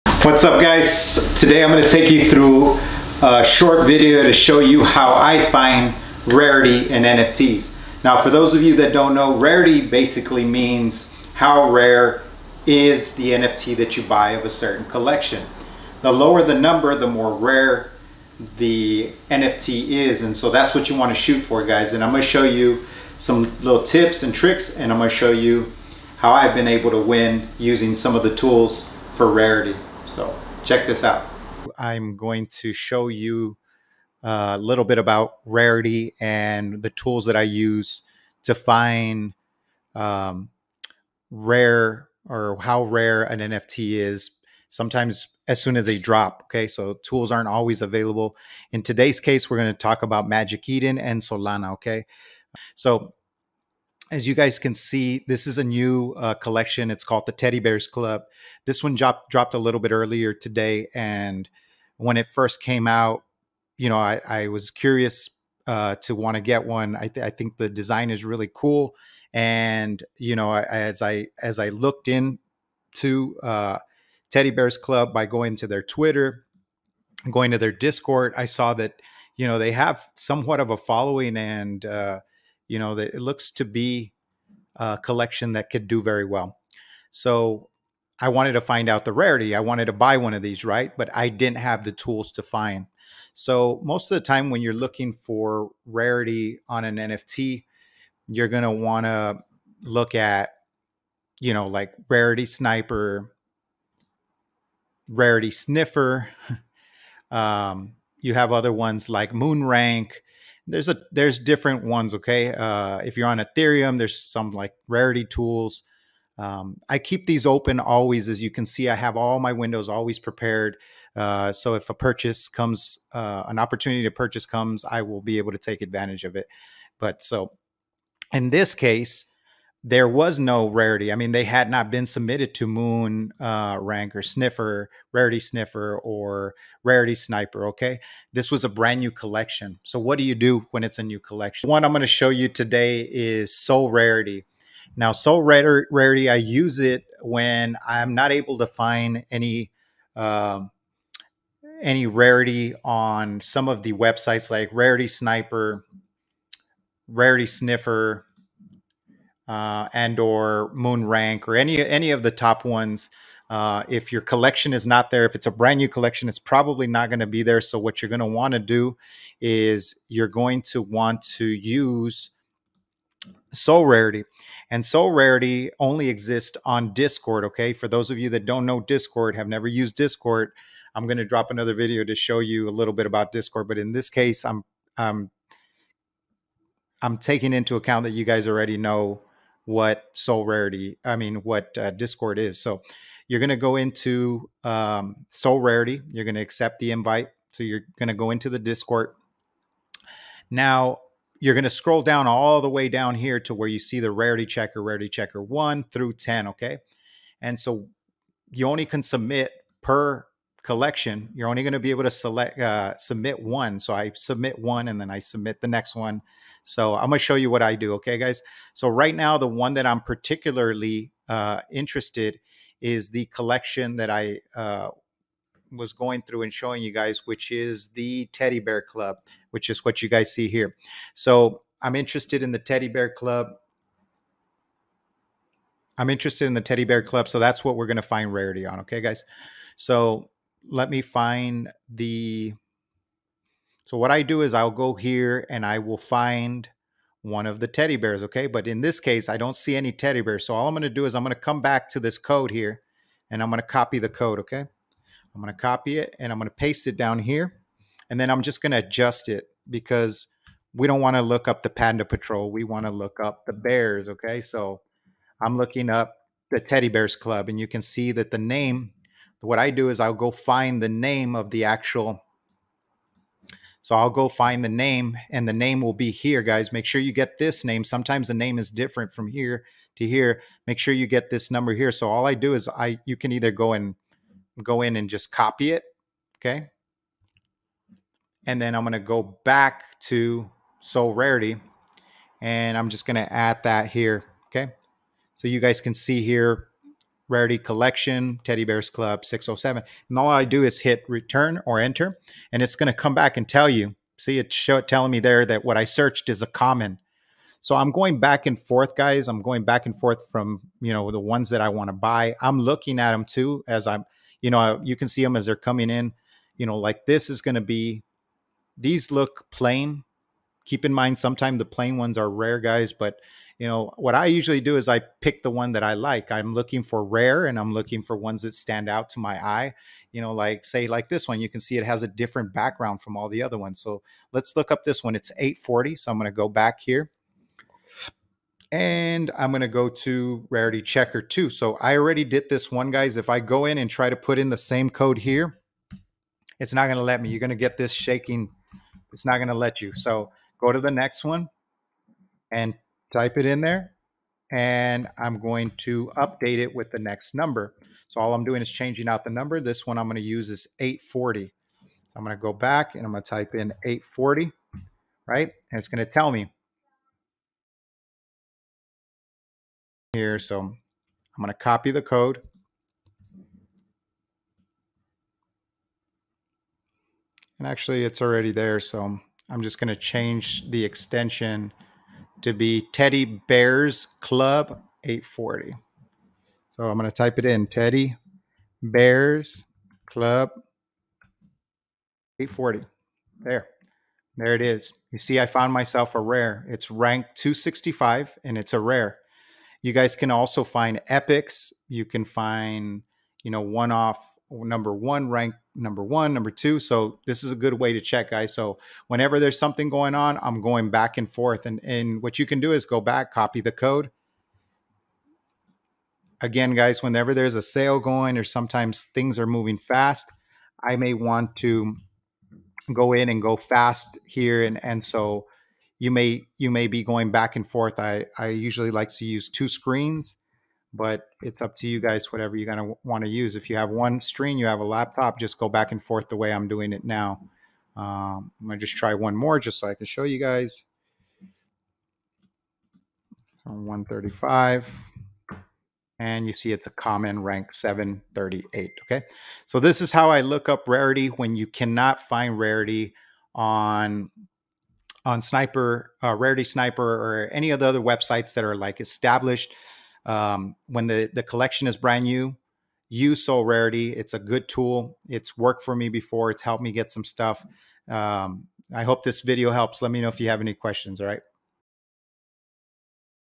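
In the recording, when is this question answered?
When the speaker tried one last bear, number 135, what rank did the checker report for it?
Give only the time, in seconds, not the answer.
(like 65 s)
447 s.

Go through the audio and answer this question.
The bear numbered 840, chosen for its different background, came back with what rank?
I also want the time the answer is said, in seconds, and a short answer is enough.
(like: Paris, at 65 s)
265, at 396 s.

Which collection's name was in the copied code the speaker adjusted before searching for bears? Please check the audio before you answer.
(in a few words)
Panda Patrol.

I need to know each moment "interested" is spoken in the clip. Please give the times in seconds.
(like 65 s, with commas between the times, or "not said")
221 s, 231 s, 236 s.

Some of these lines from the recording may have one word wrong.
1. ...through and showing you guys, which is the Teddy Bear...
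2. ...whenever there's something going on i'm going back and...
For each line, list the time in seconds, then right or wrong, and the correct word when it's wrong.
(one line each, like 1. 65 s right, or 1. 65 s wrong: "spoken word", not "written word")
1. 226 s right
2. 409 s right.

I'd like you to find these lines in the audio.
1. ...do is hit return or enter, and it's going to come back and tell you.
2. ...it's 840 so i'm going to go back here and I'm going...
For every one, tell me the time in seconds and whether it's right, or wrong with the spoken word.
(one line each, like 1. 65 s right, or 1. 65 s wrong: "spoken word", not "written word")
1. 300 s right
2. 335 s right.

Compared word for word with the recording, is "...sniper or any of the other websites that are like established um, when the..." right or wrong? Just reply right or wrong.
right.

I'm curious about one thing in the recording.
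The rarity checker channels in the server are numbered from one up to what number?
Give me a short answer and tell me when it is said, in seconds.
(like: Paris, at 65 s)
10, at 204 s.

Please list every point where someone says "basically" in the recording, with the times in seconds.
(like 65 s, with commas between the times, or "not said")
9 s.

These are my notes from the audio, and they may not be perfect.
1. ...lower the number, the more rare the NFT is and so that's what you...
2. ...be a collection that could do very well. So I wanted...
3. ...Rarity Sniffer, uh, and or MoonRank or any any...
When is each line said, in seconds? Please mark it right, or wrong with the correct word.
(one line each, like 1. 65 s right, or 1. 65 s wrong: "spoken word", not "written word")
1. 16 s right
2. 83 s right
3. 157 s right.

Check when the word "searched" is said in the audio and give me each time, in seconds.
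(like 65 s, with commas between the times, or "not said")
305 s.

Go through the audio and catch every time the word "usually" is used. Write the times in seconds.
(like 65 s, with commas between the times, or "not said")
324 s, 428 s.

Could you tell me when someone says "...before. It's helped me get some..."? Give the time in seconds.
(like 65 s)
466 s.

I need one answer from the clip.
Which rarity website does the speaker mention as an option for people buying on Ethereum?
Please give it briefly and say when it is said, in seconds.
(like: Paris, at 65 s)
Rarity Tools, at 114 s.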